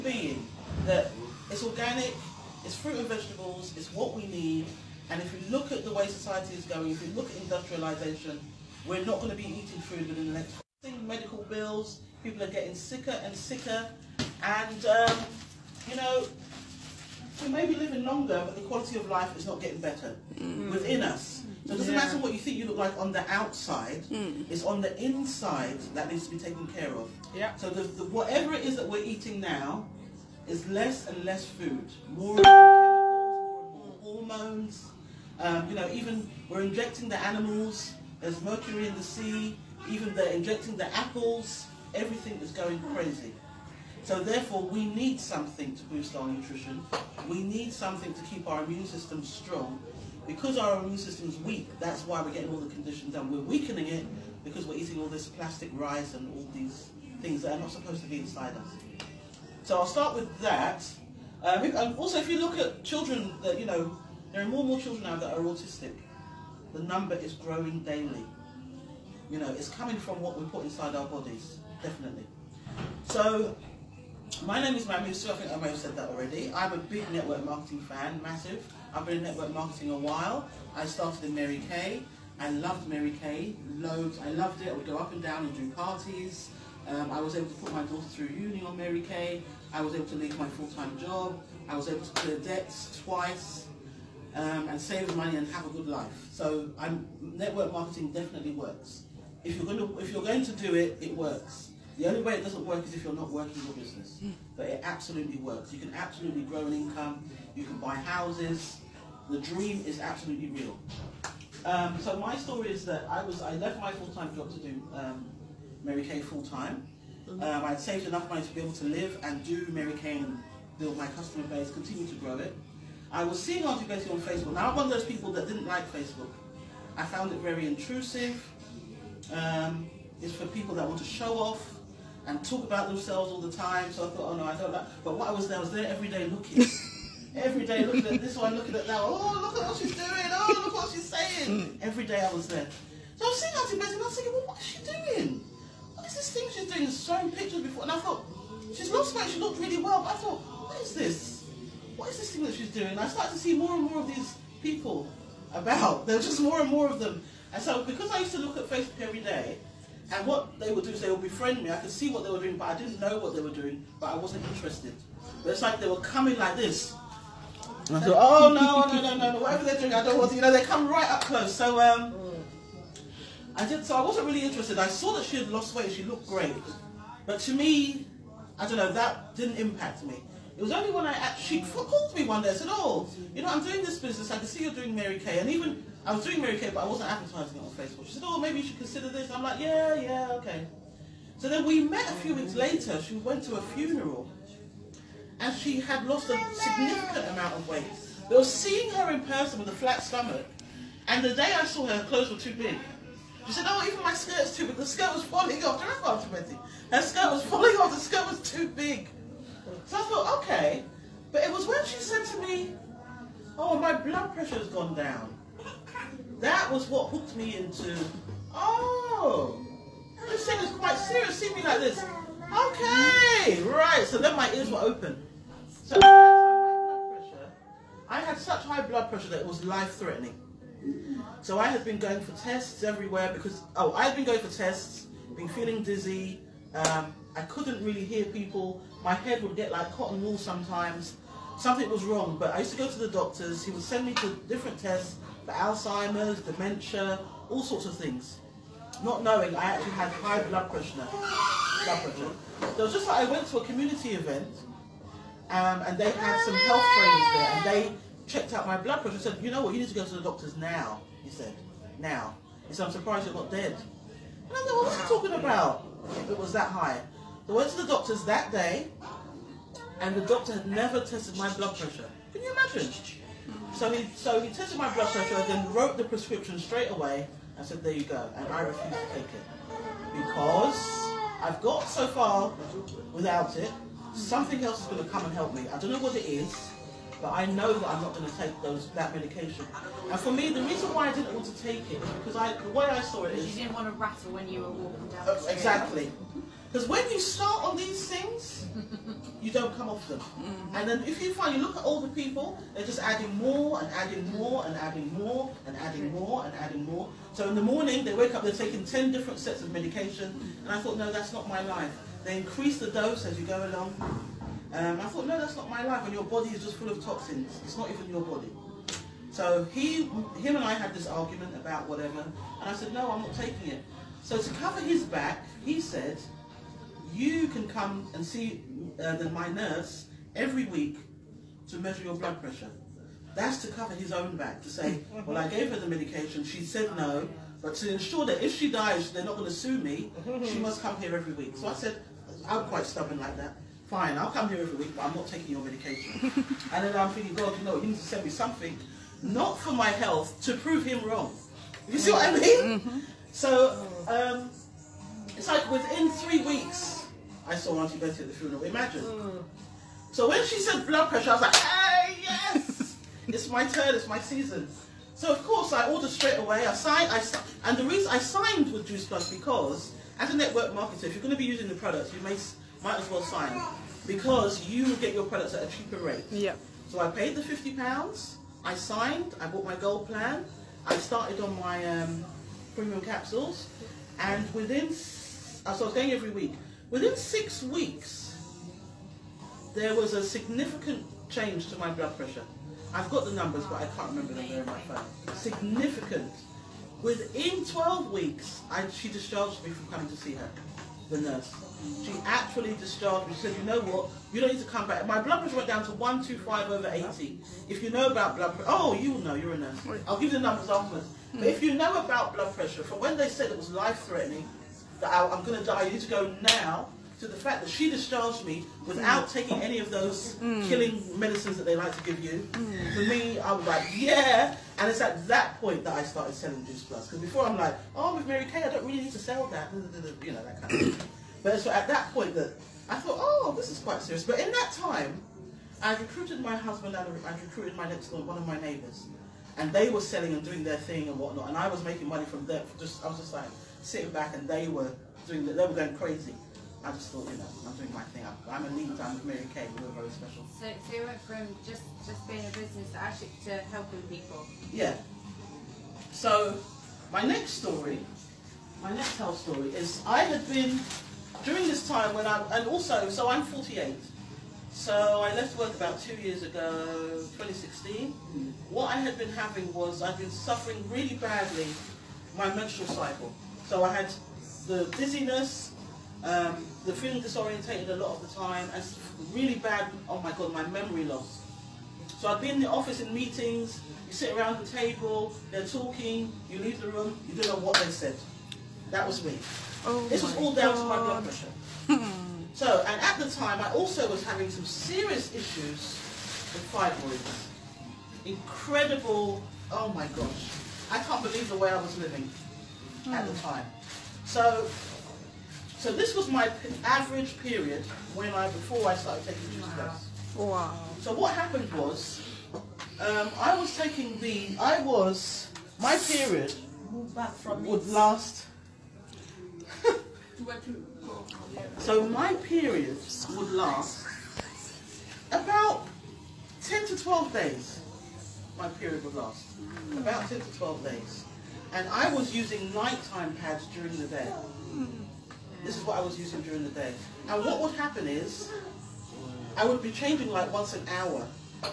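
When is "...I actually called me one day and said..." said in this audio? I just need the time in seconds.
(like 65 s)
181 s.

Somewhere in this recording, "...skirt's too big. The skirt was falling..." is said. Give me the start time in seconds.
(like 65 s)
204 s.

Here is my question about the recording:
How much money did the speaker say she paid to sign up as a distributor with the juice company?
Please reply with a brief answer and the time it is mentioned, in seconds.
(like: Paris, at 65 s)
50 pounds, at 377 s.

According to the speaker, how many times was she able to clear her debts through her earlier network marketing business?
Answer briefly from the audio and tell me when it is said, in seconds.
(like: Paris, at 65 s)
twice, at 93 s.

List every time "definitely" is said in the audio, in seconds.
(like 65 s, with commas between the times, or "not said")
71 s, 98 s.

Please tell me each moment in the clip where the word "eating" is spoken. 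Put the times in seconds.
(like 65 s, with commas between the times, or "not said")
9 s, 29 s, 54 s.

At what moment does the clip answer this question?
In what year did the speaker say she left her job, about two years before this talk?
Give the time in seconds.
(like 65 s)
467 s.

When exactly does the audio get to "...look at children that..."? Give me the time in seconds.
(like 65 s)
62 s.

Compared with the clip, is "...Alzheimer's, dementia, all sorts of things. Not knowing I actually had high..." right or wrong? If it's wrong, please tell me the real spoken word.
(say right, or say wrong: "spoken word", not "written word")
right.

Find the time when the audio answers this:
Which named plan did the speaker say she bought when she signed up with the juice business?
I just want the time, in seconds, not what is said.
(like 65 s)
379 s.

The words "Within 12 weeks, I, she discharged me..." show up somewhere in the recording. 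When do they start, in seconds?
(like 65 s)
397 s.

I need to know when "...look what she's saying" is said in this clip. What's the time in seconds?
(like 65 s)
140 s.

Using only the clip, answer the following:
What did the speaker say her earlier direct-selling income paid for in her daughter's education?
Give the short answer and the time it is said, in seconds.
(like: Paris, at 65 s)
uni, at 88 s.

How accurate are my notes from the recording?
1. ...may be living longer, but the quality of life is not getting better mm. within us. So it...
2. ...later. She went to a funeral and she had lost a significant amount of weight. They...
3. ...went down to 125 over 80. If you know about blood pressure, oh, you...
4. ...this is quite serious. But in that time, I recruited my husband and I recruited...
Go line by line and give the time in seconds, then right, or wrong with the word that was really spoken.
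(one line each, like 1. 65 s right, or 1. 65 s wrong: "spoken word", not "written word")
1. 17 s right
2. 192 s right
3. 405 s right
4. 433 s right.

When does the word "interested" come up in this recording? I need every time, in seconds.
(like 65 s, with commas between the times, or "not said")
164 s, 174 s.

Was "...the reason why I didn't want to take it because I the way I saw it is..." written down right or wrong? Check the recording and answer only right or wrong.
right.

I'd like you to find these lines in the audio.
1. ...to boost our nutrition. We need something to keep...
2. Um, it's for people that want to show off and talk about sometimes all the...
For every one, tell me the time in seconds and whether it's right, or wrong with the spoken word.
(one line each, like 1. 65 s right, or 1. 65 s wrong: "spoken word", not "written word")
1. 45 s right
2. 129 s wrong: "themselves", not "sometimes".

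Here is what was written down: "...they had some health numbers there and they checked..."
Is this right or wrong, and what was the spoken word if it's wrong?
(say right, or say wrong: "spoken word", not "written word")
wrong: "trainers", not "numbers".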